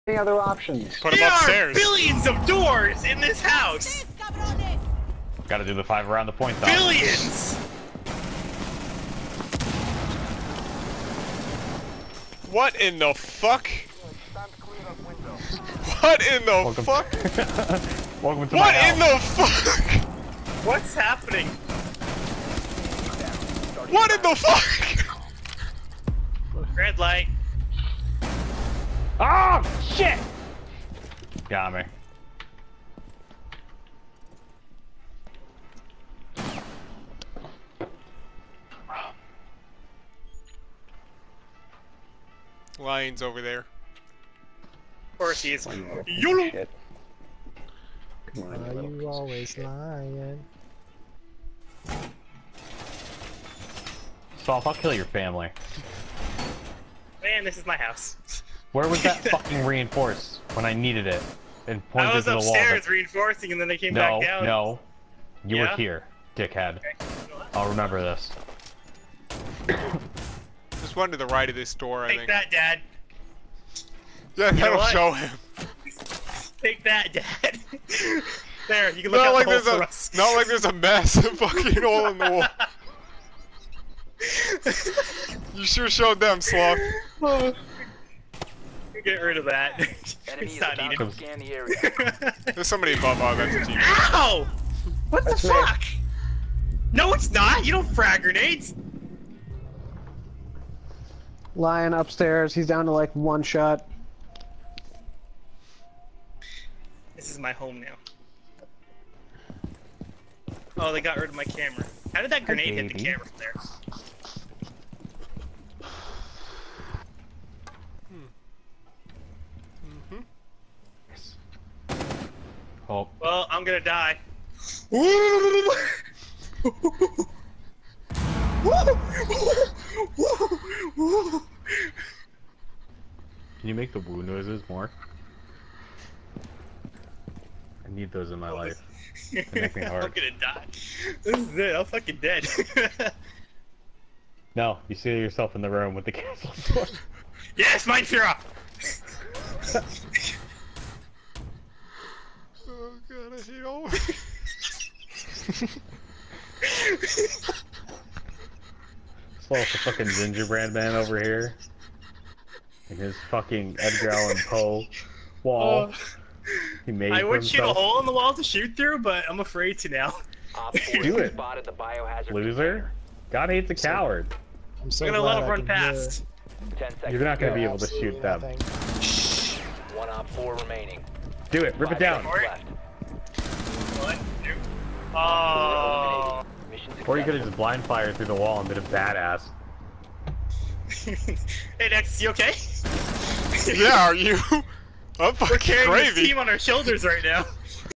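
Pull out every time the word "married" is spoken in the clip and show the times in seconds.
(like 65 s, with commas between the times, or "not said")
not said.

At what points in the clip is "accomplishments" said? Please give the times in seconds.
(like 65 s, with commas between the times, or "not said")
not said.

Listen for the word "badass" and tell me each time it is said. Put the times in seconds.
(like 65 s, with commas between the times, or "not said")
188 s.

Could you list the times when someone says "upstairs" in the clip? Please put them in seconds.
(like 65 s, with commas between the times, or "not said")
1 s, 62 s, 101 s.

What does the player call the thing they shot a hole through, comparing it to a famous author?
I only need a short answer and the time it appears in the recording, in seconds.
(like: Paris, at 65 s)
Edgar Allan Poe wall, at 163 s.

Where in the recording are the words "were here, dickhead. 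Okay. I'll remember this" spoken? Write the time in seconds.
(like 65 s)
65 s.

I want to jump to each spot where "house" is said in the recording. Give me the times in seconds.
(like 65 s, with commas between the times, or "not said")
3 s, 18 s, 57 s.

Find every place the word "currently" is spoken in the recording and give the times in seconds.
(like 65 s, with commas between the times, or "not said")
not said.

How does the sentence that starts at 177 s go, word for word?
You're not gonna be able to shoot them.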